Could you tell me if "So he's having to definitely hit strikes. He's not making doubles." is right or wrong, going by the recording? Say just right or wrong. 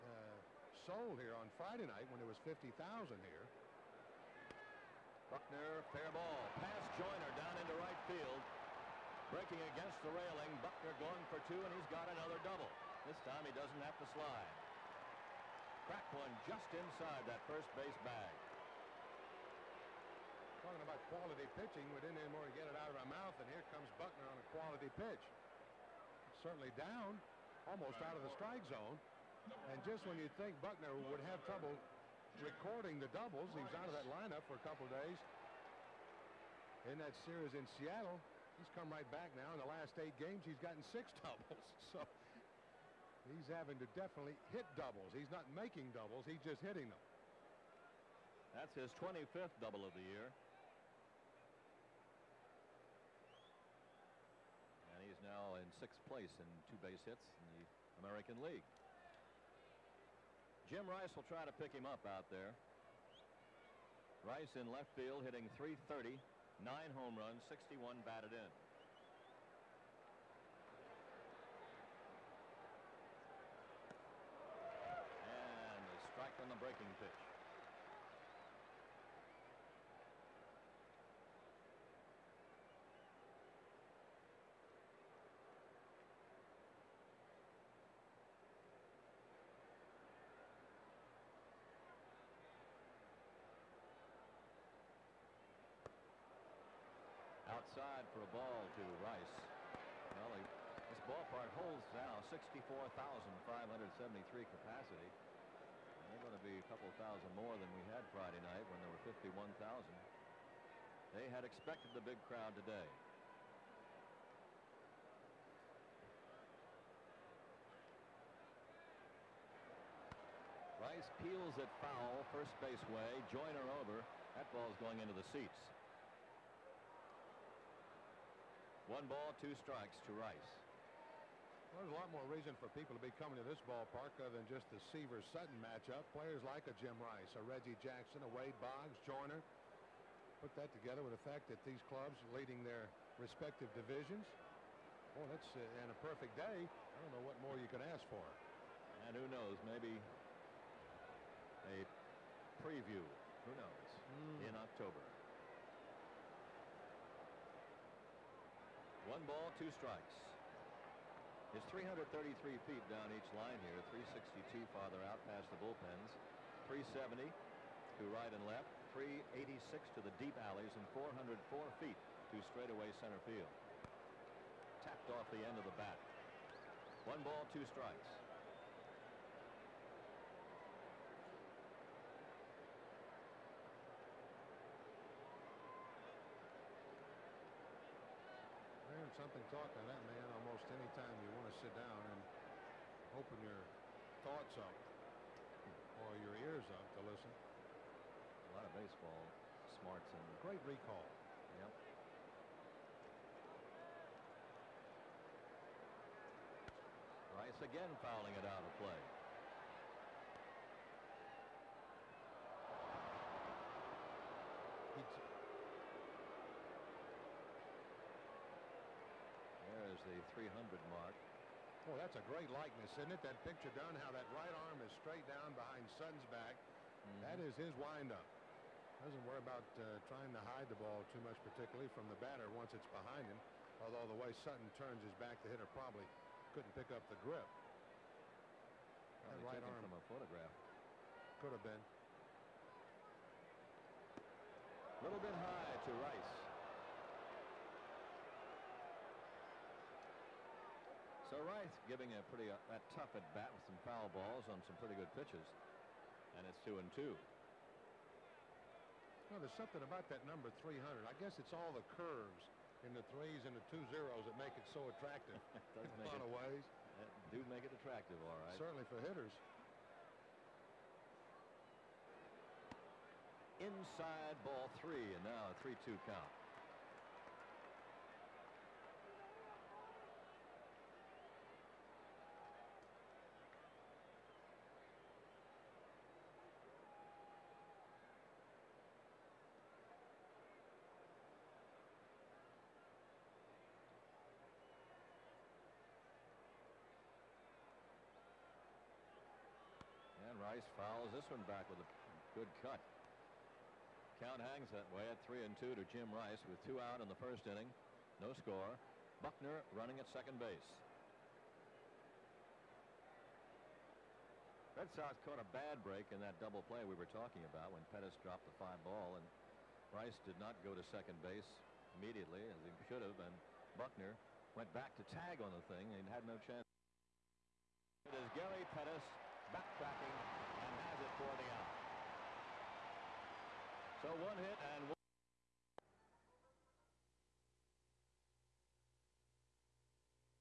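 wrong.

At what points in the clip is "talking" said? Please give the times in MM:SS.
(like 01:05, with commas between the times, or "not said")
00:20, 05:17.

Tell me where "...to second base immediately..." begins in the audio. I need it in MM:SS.
05:20.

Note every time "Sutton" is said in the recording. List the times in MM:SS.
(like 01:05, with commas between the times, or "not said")
02:15, 03:45, 03:54.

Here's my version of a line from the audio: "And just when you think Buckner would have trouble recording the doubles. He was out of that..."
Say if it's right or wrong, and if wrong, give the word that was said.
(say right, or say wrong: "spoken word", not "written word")
right.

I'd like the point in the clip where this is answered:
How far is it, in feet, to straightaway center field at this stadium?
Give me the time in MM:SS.
02:50.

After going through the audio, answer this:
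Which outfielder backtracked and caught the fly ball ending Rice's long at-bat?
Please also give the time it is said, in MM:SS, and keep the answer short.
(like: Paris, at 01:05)
Gary Pettis, at 05:28.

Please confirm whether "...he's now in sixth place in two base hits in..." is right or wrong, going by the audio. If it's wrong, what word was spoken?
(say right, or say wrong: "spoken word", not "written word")
right.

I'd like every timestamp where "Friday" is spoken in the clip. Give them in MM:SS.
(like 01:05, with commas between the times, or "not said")
00:01, 01:48.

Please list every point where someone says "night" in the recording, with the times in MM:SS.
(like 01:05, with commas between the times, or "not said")
00:01, 01:48.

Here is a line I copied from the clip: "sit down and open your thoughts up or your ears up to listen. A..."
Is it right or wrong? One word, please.
right.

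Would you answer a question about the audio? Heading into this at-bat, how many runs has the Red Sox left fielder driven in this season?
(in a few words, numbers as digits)
61.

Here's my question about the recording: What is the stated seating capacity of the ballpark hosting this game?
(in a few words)
64,573.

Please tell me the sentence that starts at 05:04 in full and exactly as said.
Count hangs that way at three and two to Jim Rice with two out in the first inning.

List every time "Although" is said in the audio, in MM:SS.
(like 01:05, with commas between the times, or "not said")
03:53.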